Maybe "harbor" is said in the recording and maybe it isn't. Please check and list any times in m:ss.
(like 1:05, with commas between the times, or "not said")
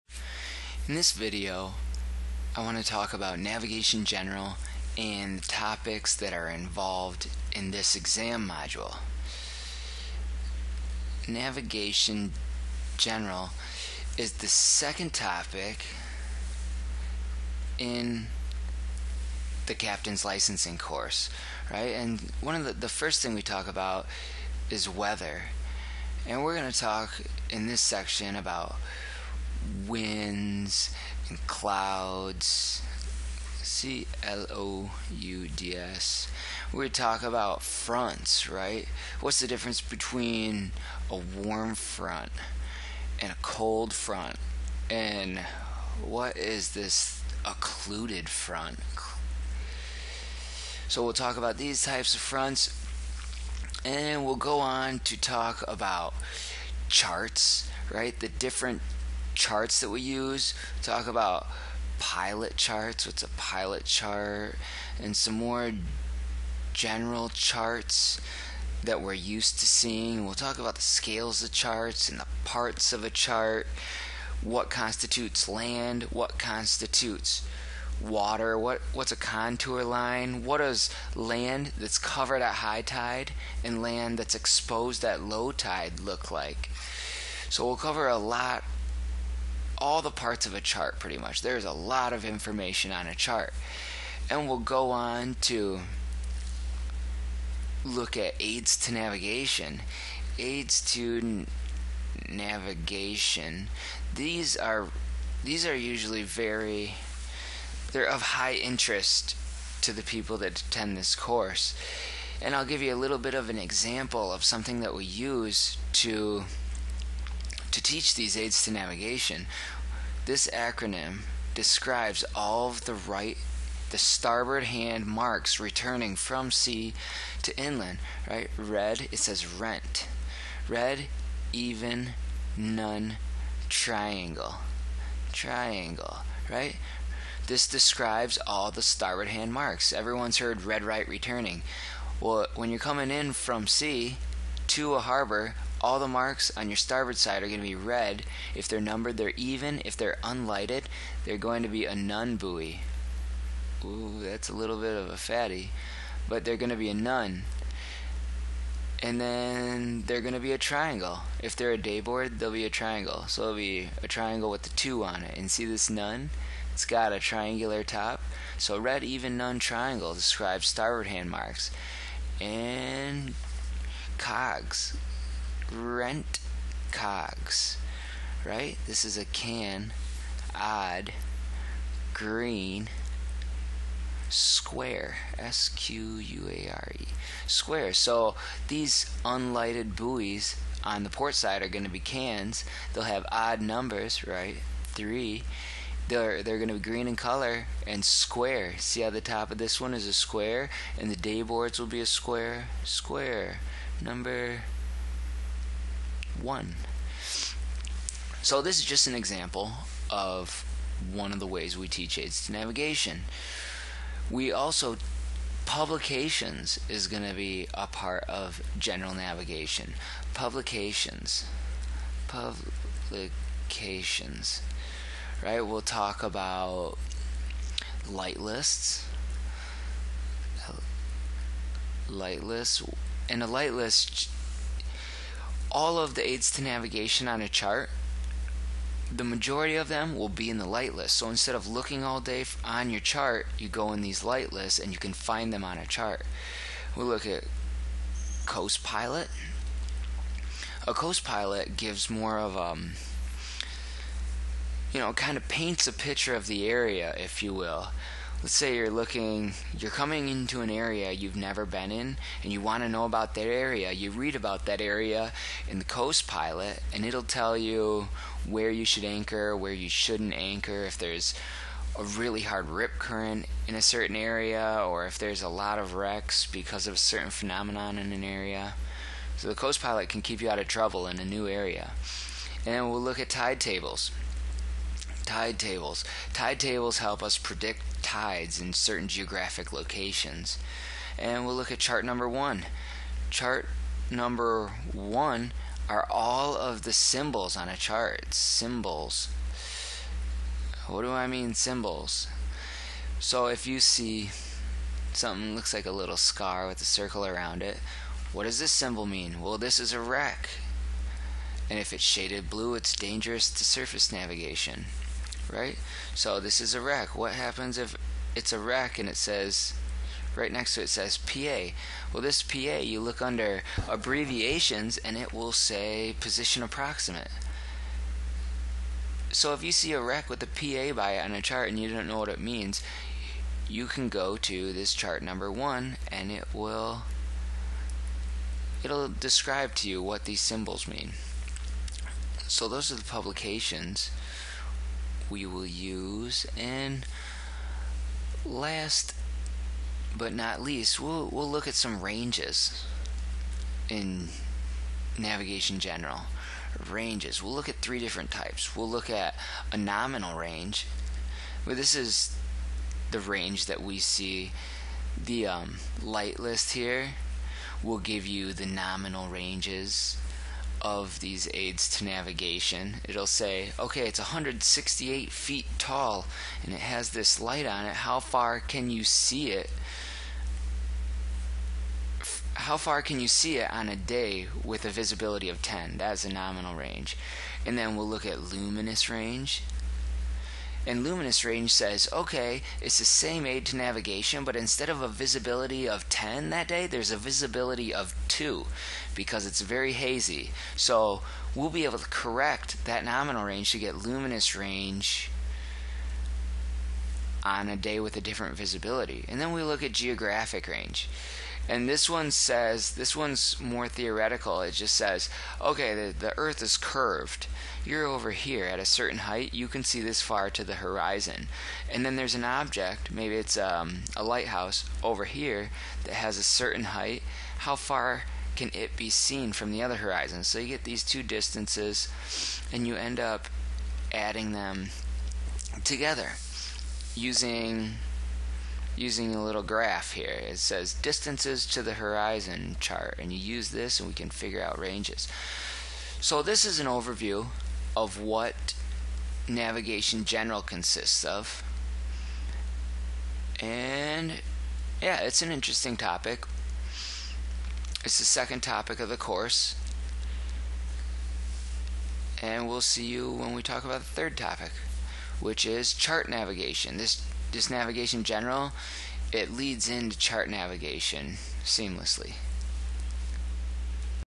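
2:24.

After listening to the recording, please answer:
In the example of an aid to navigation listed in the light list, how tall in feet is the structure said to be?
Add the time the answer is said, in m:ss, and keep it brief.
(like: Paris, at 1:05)
168, at 6:14.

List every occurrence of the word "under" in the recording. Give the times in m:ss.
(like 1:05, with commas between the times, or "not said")
5:23.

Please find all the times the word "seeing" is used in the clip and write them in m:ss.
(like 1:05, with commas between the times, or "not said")
1:09.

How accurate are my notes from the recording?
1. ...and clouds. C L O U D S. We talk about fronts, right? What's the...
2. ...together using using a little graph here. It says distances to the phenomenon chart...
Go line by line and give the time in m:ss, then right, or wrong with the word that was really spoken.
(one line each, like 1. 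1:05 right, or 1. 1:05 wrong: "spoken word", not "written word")
1. 0:31 right
2. 7:15 wrong: "horizon", not "phenomenon".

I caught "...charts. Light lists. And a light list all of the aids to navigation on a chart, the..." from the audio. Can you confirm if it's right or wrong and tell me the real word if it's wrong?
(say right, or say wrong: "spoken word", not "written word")
wrong: "lists", not "charts".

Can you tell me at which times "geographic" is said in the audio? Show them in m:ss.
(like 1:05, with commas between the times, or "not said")
4:49, 6:49.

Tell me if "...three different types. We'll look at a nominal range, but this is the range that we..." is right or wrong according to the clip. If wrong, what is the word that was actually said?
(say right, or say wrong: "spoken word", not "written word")
right.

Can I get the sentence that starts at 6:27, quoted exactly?
And then we'll look at luminous range.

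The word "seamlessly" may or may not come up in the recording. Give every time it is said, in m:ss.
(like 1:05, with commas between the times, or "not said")
7:51.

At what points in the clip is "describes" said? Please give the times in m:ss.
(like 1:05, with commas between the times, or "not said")
2:01, 2:17, 2:50, 5:39.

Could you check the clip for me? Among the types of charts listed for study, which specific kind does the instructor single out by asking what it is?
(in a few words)
Pilot chart.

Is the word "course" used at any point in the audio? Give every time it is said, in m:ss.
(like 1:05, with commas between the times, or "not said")
0:20, 1:51, 7:39.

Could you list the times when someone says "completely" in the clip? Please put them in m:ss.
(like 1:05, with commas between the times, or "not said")
not said.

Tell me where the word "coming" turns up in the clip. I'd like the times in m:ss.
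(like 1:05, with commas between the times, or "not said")
2:22, 4:19.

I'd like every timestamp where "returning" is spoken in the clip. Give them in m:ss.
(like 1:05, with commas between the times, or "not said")
2:05, 2:21.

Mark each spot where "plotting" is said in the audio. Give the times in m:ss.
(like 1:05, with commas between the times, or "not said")
not said.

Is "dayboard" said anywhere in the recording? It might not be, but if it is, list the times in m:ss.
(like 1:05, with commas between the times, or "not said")
2:41, 3:21.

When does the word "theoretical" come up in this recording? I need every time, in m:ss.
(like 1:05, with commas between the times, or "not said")
6:53.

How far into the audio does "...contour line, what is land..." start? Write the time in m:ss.
1:19.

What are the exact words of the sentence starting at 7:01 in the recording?
And then there's an object, maybe it's um, a lighthouse over here that has a certain height.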